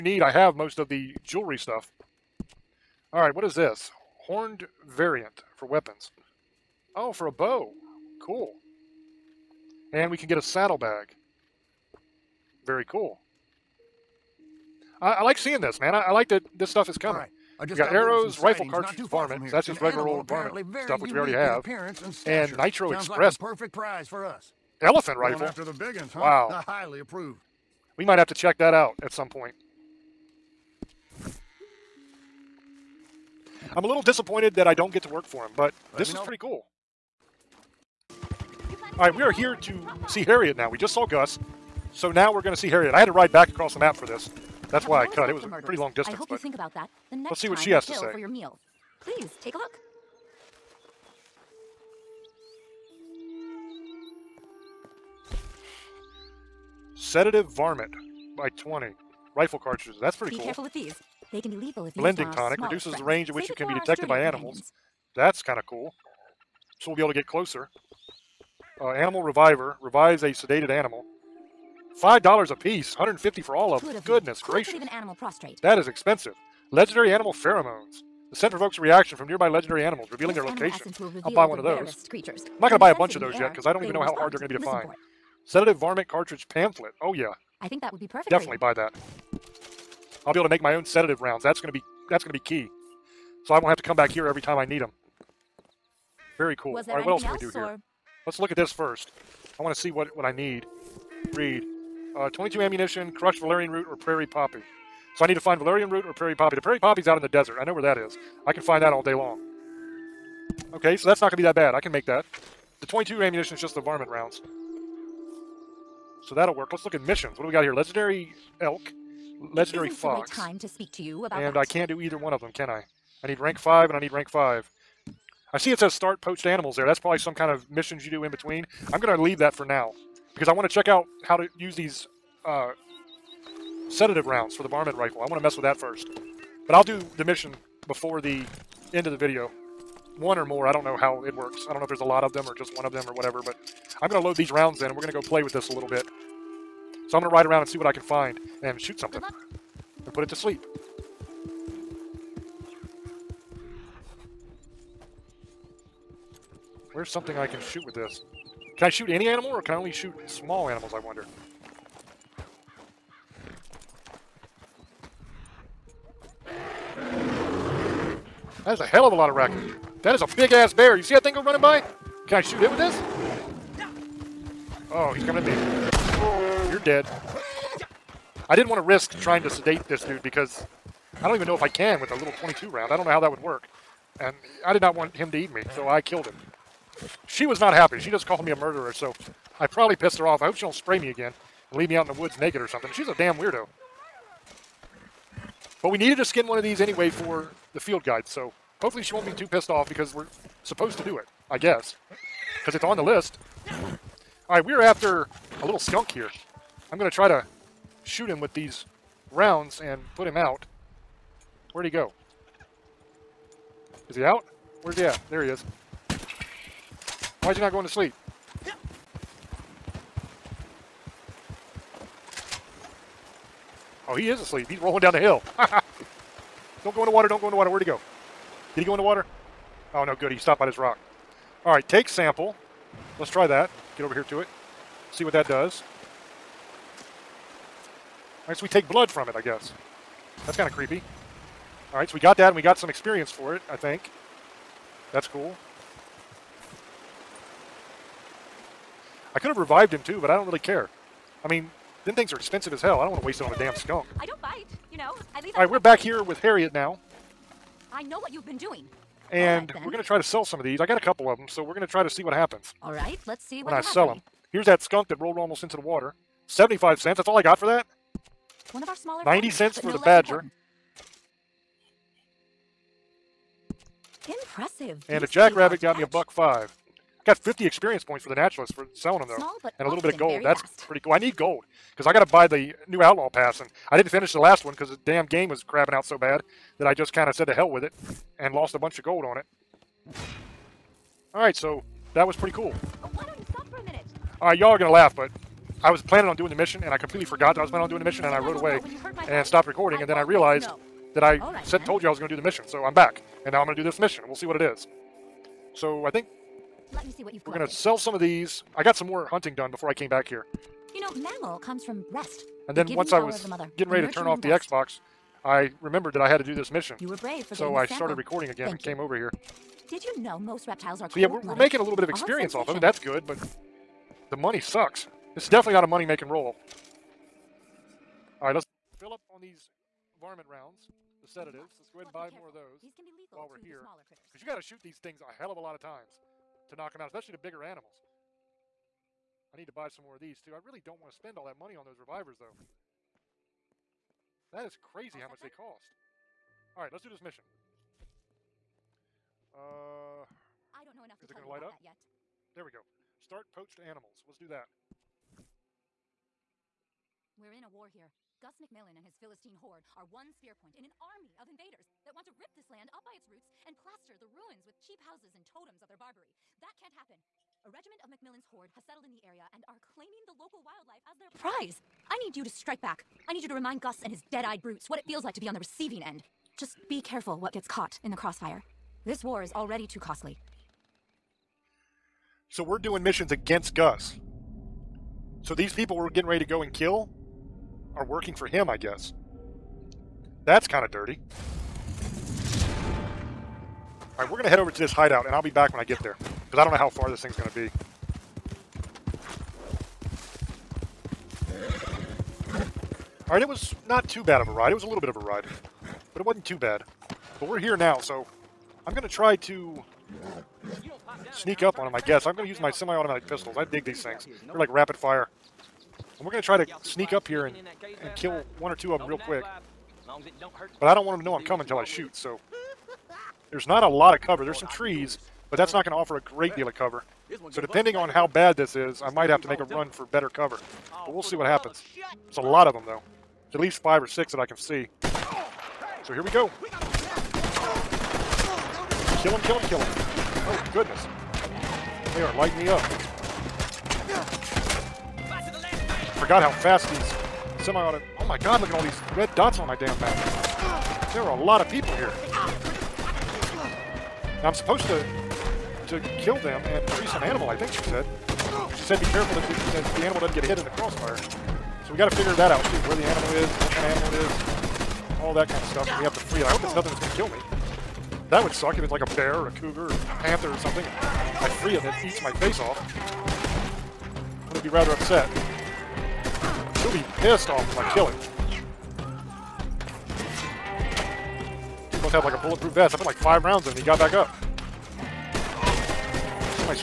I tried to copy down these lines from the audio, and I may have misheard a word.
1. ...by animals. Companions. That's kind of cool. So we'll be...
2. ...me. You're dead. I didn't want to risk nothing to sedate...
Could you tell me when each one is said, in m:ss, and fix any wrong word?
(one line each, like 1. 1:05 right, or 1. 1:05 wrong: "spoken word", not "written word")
1. 1:04 right
2. 2:55 wrong: "trying", not "nothing".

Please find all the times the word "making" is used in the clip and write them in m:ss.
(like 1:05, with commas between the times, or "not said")
5:21, 5:25.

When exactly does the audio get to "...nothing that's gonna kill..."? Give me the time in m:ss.
7:46.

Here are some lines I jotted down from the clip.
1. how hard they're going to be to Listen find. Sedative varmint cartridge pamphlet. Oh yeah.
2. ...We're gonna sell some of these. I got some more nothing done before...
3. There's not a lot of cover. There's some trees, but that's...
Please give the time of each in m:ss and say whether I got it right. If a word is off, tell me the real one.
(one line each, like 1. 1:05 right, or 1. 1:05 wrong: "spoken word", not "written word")
1. 1:24 right
2. 5:07 wrong: "hunting", not "nothing"
3. 7:03 right.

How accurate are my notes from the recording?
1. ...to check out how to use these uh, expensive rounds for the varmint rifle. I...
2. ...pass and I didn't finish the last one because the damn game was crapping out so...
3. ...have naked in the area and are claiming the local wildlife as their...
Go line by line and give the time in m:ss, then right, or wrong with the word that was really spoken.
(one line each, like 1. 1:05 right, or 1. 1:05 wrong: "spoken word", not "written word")
1. 2:10 wrong: "sedative", not "expensive"
2. 4:43 right
3. 6:08 wrong: "settled", not "naked".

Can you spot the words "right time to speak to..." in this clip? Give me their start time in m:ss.
2:00.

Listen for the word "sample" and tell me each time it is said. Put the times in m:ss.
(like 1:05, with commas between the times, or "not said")
3:52, 5:17.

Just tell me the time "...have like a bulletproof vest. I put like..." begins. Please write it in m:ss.
8:02.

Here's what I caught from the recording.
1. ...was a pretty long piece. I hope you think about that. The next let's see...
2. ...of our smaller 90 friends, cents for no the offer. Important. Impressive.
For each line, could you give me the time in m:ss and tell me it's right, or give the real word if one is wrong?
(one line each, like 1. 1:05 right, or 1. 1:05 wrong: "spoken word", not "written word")
1. 0:45 wrong: "distance", not "piece"
2. 4:28 wrong: "badger", not "offer".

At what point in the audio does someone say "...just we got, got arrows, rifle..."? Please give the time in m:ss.
0:17.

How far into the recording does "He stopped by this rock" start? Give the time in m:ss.
3:50.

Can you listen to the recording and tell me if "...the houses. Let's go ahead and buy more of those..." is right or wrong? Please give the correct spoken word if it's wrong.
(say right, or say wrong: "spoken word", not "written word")
wrong: "sedatives", not "houses".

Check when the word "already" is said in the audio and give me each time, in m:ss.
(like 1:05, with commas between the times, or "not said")
0:21, 6:19.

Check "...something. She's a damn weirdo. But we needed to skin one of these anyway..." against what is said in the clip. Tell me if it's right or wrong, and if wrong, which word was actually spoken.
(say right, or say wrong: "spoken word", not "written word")
right.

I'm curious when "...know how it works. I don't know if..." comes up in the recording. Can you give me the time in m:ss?
2:20.